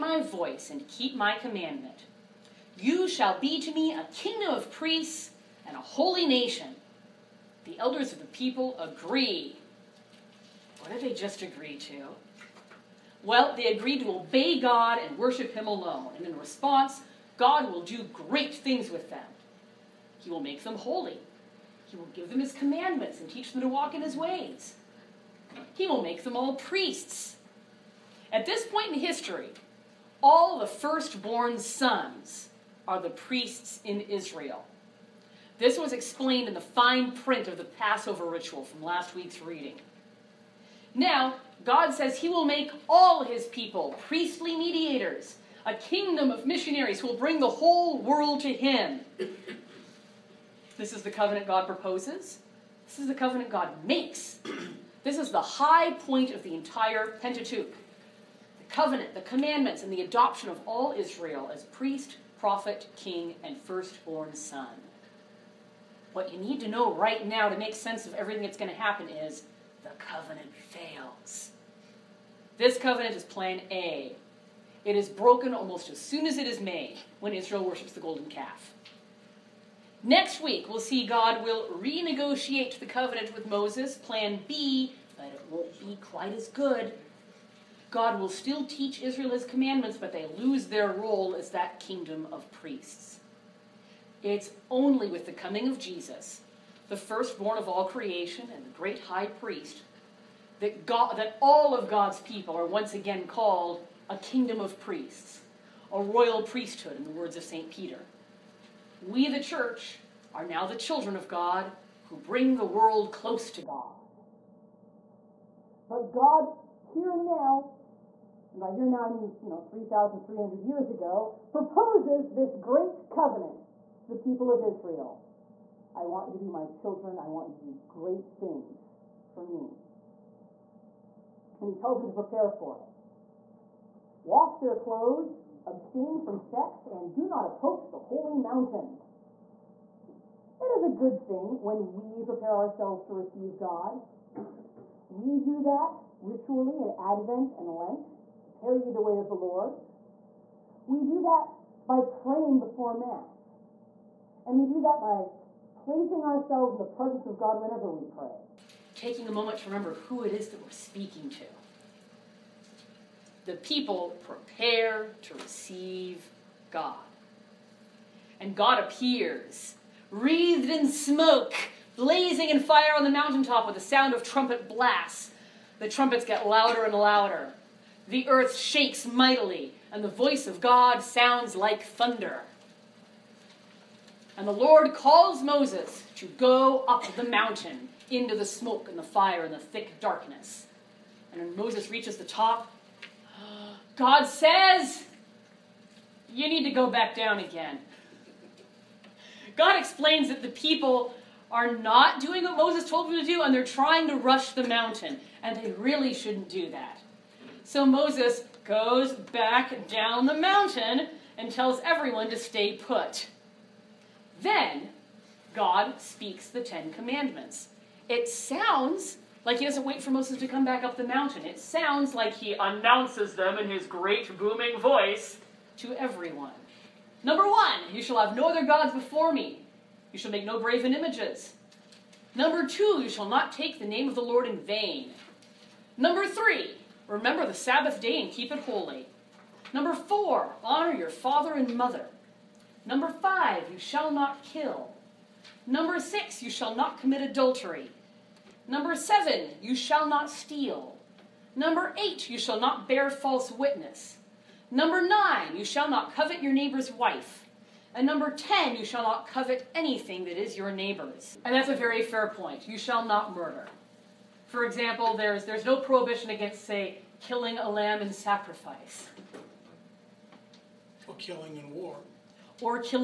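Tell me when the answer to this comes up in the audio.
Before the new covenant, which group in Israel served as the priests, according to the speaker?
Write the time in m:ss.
0:30.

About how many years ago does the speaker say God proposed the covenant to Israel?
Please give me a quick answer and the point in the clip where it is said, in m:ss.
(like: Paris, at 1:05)
3,300 years, at 1:59.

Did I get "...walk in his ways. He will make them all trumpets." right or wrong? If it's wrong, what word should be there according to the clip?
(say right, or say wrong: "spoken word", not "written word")
wrong: "priests", not "trumpets".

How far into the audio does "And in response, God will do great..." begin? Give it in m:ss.
0:16.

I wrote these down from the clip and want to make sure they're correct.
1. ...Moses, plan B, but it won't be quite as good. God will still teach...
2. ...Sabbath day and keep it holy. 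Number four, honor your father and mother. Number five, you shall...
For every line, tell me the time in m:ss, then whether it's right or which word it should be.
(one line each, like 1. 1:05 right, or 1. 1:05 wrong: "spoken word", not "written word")
1. 1:23 right
2. 3:57 right.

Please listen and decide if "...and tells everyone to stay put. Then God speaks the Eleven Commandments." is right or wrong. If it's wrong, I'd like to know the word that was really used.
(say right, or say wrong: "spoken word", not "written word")
wrong: "Ten", not "Eleven".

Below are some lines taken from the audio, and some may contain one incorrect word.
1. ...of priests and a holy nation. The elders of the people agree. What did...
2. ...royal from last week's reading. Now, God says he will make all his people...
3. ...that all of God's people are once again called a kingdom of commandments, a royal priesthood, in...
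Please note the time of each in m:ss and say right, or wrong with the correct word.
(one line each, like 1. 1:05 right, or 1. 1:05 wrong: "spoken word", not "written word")
1. 0:04 right
2. 0:38 wrong: "ritual", not "royal"
3. 1:41 wrong: "priests", not "commandments".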